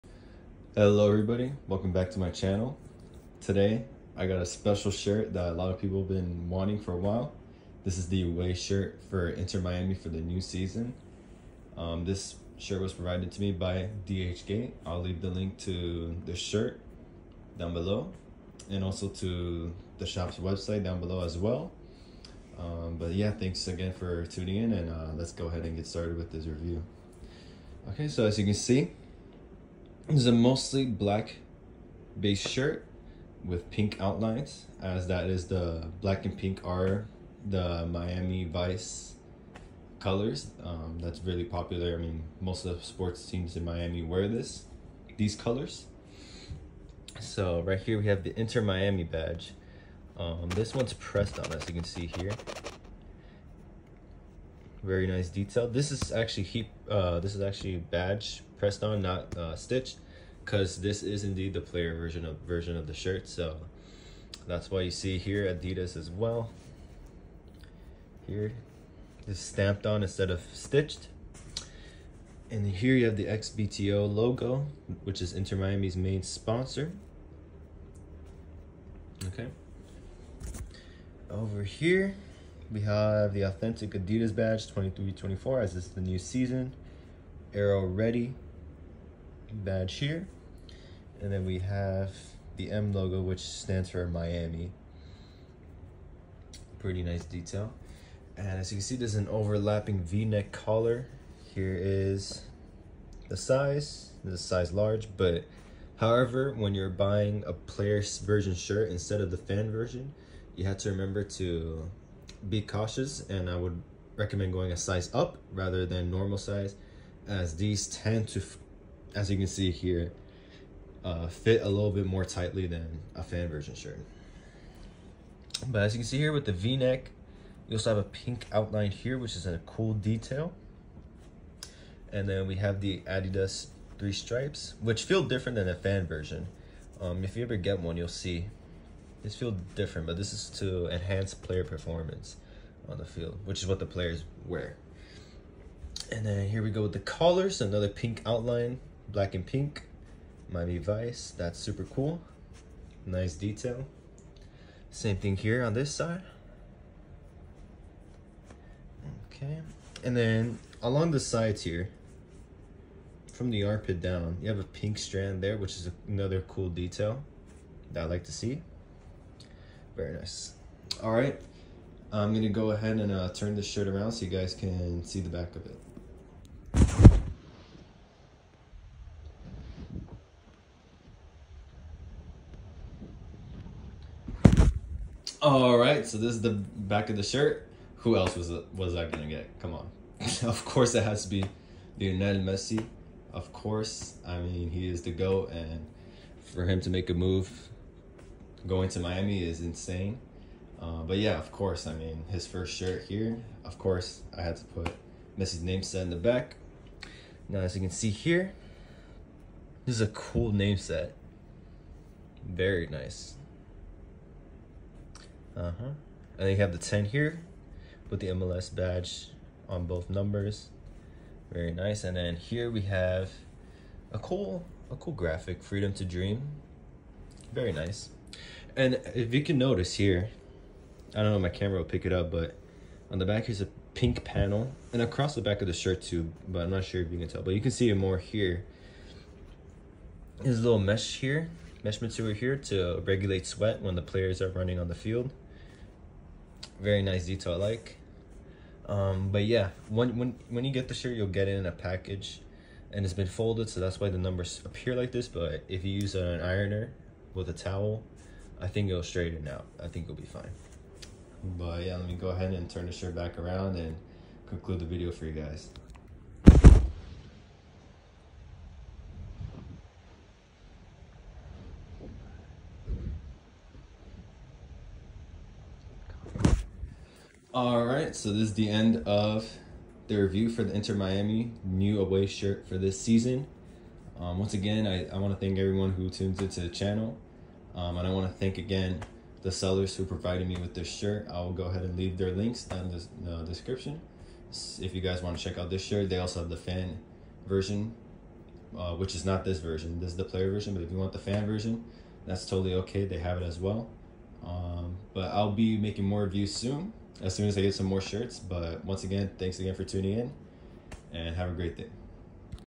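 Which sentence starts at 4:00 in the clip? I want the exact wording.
There's a little mesh here mesh material here to regulate sweat when the players are running on the field.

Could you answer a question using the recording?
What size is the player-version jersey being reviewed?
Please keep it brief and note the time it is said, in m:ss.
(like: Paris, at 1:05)
Large, at 1:44.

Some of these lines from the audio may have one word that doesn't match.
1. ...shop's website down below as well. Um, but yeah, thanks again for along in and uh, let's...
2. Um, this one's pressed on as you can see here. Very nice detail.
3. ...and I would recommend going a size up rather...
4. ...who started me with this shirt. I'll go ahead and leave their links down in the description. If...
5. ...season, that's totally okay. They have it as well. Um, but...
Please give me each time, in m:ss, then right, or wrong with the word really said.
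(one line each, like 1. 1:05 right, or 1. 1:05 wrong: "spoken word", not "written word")
1. 0:20 wrong: "tuning", not "along"
2. 0:50 right
3. 1:53 right
4. 4:49 wrong: "provided", not "started"
5. 5:01 wrong: "version", not "season".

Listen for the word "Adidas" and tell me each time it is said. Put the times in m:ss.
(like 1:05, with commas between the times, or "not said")
1:05, 1:23, 2:13.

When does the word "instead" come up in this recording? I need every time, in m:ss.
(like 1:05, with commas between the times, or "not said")
1:10, 1:48.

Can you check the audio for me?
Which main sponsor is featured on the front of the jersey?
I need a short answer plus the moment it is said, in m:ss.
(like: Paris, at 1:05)
XBTO, at 1:13.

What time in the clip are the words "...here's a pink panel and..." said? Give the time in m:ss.
3:53.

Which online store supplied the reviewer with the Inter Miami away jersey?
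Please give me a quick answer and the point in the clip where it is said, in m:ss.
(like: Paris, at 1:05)
DHgate, at 0:14.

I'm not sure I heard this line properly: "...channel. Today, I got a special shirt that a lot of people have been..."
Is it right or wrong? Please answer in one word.
right.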